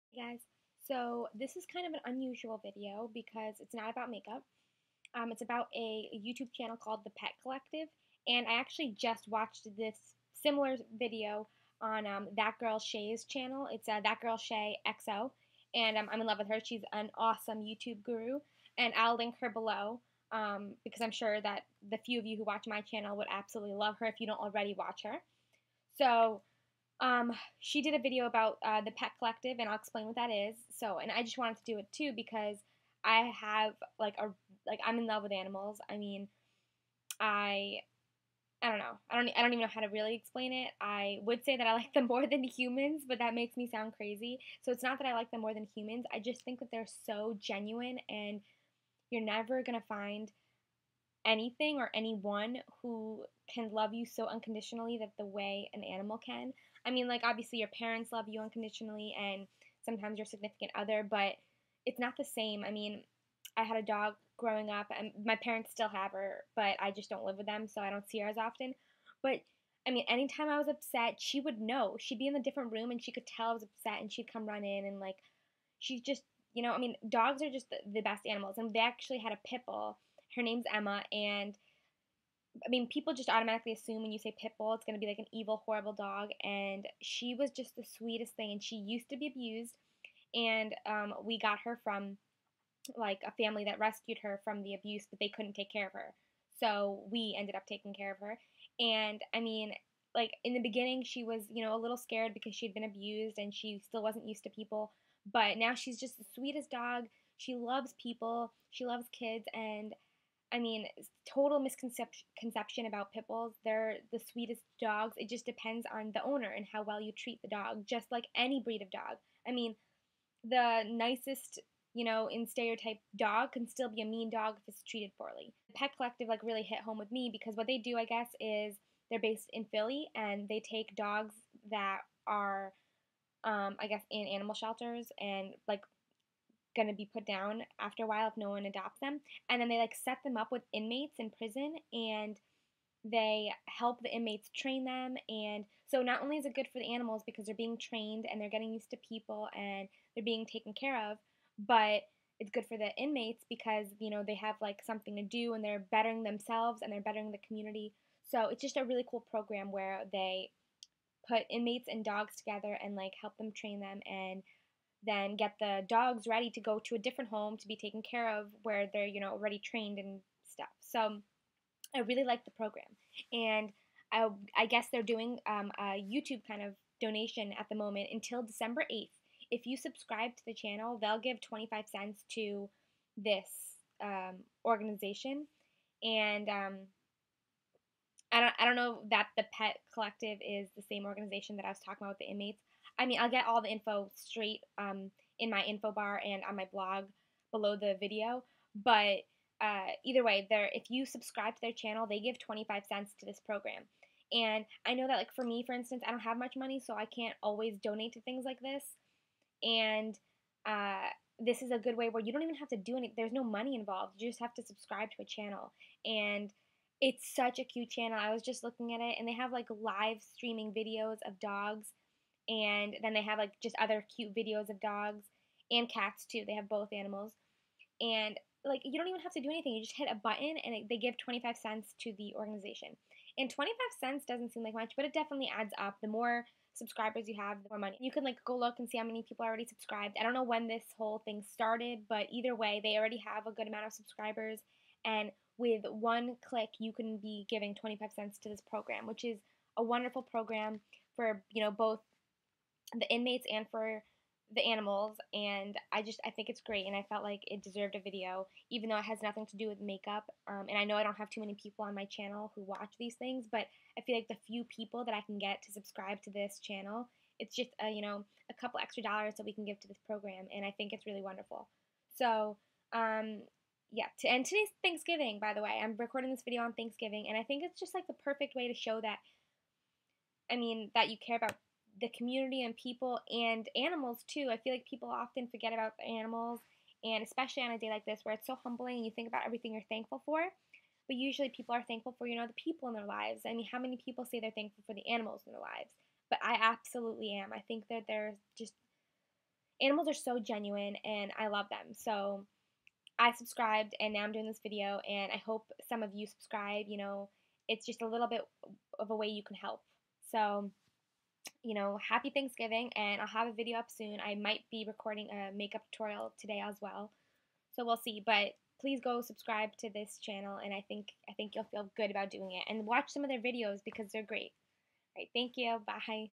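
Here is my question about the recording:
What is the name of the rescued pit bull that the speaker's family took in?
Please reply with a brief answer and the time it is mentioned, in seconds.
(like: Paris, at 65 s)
Emma, at 80 s.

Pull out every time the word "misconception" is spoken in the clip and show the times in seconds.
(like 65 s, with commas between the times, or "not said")
111 s.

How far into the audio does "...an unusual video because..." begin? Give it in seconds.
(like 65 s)
1 s.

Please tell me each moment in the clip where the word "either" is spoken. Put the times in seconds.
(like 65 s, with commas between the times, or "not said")
200 s, 242 s.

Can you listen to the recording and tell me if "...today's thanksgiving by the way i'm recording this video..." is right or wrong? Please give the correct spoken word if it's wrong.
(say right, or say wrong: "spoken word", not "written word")
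right.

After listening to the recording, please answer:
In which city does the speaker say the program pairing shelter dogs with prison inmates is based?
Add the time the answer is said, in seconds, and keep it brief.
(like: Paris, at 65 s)
Philly, at 129 s.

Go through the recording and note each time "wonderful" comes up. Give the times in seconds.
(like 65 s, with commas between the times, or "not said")
249 s, 271 s.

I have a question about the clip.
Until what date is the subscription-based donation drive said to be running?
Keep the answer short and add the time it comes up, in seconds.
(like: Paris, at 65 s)
December 8th, at 178 s.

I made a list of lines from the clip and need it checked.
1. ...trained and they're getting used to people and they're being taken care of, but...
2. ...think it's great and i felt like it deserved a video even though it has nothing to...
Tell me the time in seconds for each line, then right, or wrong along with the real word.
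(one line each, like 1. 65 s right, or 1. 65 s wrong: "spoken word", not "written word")
1. 147 s right
2. 256 s right.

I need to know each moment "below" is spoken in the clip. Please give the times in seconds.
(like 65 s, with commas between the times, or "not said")
19 s, 197 s.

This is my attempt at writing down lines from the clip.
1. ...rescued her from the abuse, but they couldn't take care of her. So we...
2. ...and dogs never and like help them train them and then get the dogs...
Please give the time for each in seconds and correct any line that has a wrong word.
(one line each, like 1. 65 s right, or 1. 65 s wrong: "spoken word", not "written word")
1. 93 s right
2. 161 s wrong: "together", not "never".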